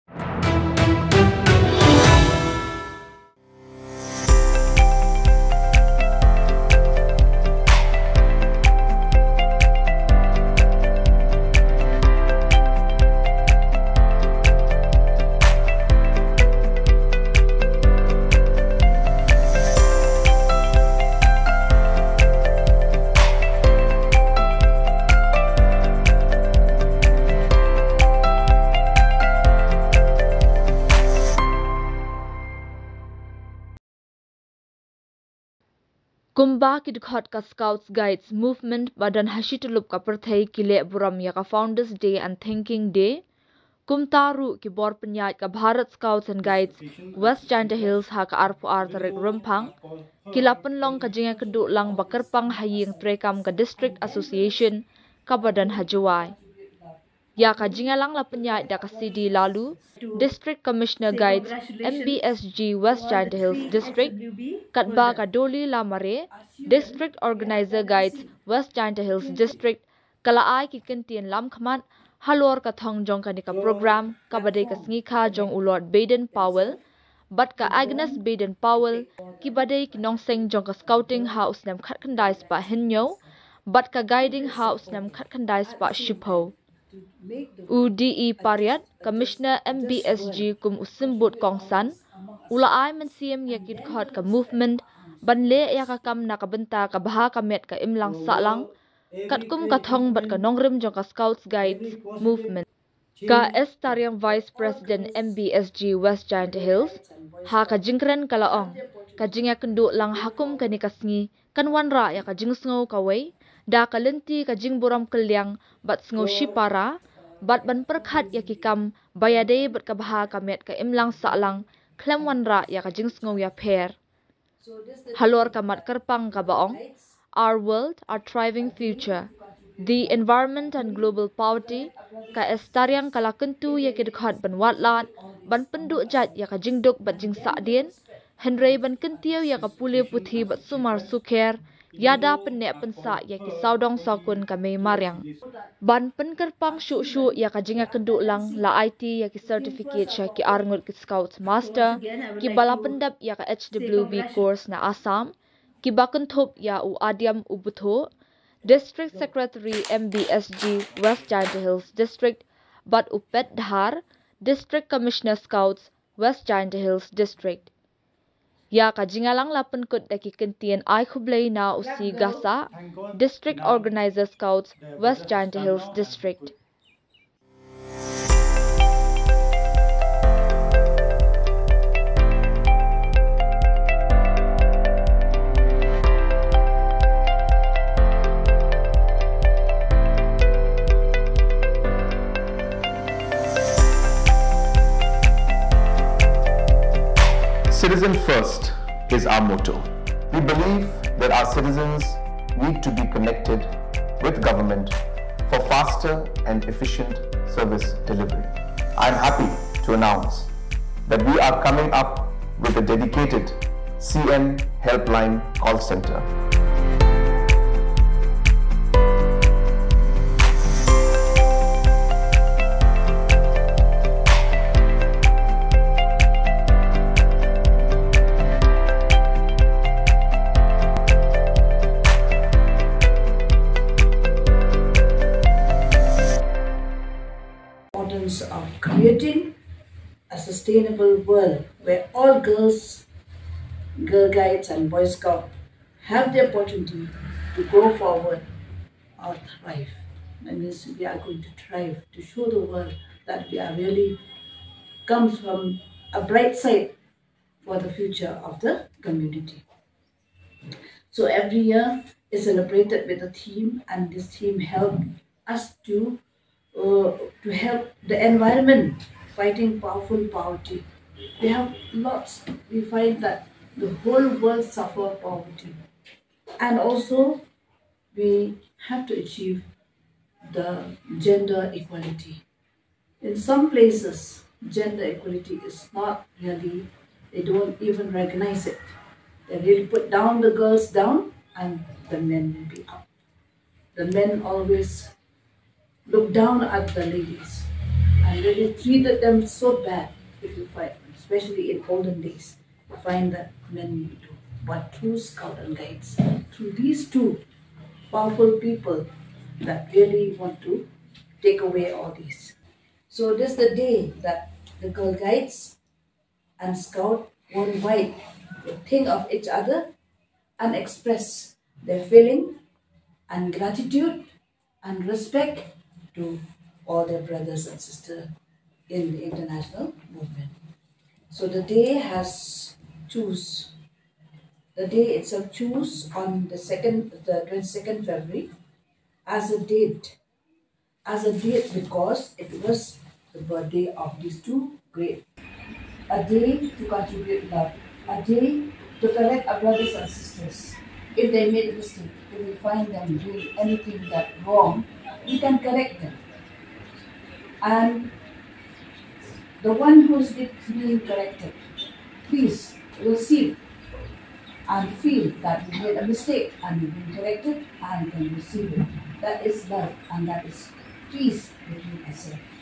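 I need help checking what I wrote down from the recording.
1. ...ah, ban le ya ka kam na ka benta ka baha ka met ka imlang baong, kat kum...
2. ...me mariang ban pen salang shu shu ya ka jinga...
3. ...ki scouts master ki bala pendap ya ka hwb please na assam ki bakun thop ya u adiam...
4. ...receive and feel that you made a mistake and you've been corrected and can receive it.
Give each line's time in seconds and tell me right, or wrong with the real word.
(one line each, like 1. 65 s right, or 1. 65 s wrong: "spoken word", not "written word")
1. 94 s wrong: "saklang", not "baong"
2. 144 s wrong: "kerpang", not "salang"
3. 150 s wrong: "course", not "please"
4. 363 s right.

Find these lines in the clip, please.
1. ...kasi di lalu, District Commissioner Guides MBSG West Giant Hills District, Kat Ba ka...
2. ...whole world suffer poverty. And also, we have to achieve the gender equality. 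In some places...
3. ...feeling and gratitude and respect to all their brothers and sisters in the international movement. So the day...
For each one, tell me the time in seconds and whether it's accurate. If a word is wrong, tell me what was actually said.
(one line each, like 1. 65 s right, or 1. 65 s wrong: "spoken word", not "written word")
1. 58 s right
2. 274 s right
3. 322 s right.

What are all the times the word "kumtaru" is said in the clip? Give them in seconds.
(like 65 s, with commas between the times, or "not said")
43 s.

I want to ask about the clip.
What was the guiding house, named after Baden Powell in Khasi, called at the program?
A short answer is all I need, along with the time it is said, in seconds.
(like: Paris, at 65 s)
Shupo, at 85 s.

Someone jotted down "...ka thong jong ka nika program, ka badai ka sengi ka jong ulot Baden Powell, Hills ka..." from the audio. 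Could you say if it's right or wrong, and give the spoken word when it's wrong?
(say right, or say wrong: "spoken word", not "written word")
wrong: "Bat", not "Hills".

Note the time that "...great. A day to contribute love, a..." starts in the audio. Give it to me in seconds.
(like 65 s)
344 s.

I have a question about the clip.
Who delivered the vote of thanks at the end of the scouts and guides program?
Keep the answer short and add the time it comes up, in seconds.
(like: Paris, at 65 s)
District Organizer Scouts, at 173 s.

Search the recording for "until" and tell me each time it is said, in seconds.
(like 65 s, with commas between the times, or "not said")
not said.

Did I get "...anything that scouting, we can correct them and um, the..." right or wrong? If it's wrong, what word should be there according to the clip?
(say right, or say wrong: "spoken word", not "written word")
wrong: "wrong", not "scouting".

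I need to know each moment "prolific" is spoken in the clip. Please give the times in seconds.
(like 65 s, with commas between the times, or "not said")
not said.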